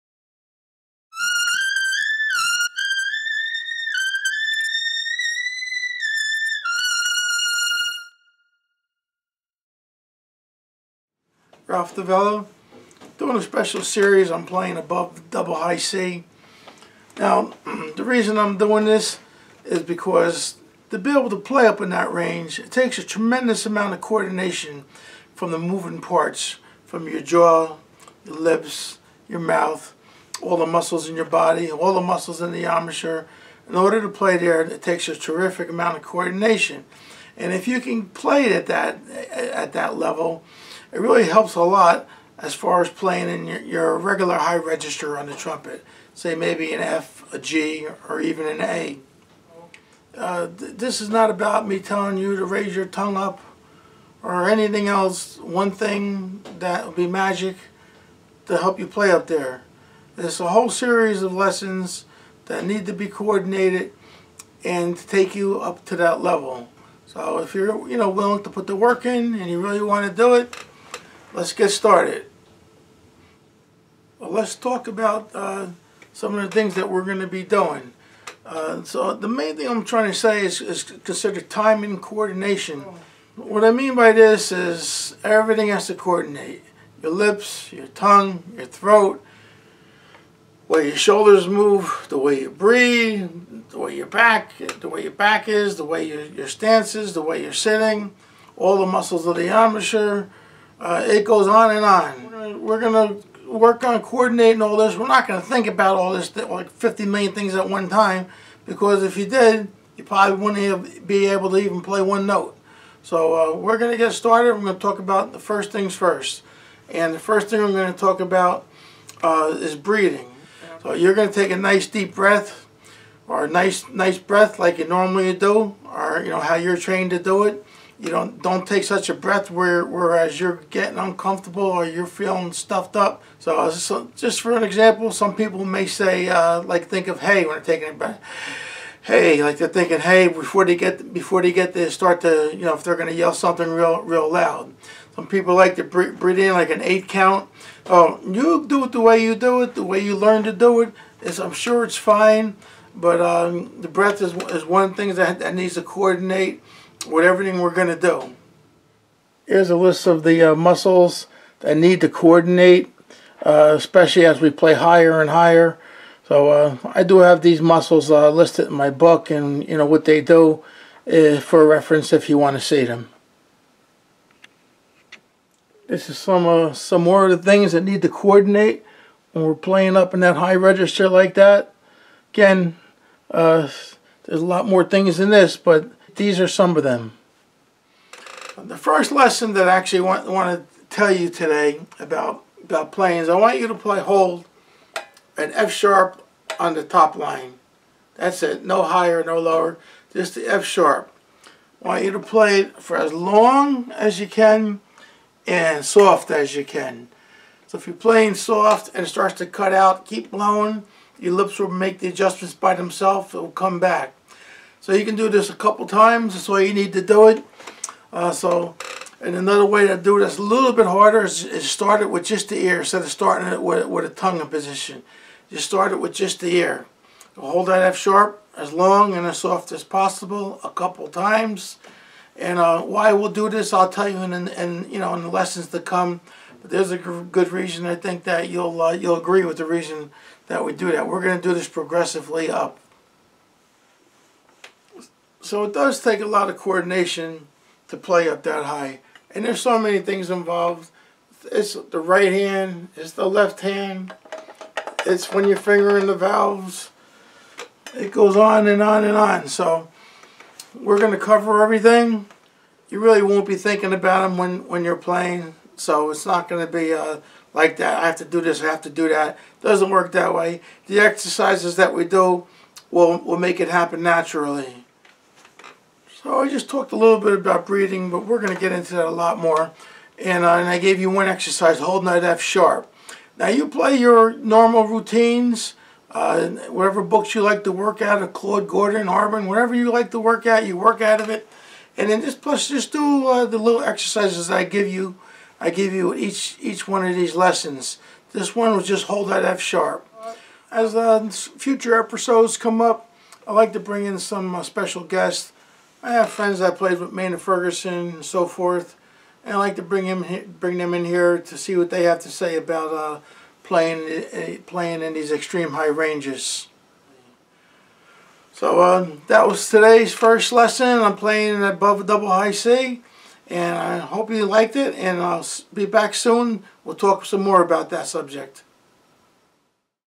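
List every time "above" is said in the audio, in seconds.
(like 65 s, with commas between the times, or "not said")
14 s, 321 s.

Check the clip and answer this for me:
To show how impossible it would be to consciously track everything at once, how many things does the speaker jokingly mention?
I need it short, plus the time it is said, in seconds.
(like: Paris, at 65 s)
50 million, at 106 s.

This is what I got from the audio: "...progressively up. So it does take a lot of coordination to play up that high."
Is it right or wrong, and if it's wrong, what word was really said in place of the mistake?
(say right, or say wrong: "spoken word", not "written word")
right.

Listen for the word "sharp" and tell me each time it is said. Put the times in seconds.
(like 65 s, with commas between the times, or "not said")
195 s, 200 s, 227 s, 282 s, 299 s.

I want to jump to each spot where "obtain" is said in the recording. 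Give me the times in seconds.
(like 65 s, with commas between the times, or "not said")
not said.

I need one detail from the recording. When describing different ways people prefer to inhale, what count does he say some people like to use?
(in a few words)
8.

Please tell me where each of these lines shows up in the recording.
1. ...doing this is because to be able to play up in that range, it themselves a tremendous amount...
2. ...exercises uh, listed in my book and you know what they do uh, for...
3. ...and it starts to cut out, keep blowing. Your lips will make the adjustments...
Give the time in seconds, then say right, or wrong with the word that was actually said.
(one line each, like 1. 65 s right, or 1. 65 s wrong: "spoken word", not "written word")
1. 18 s wrong: "takes", not "themselves"
2. 167 s wrong: "muscles", not "exercises"
3. 208 s right.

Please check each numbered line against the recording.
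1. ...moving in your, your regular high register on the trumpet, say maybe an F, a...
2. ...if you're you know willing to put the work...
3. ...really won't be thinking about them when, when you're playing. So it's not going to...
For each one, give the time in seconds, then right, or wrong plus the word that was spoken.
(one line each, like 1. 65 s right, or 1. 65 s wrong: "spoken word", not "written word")
1. 42 s wrong: "playing", not "moving"
2. 67 s right
3. 262 s right.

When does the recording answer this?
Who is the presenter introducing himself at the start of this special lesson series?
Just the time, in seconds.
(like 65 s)
11 s.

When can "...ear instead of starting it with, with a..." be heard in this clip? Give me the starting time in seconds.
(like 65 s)
222 s.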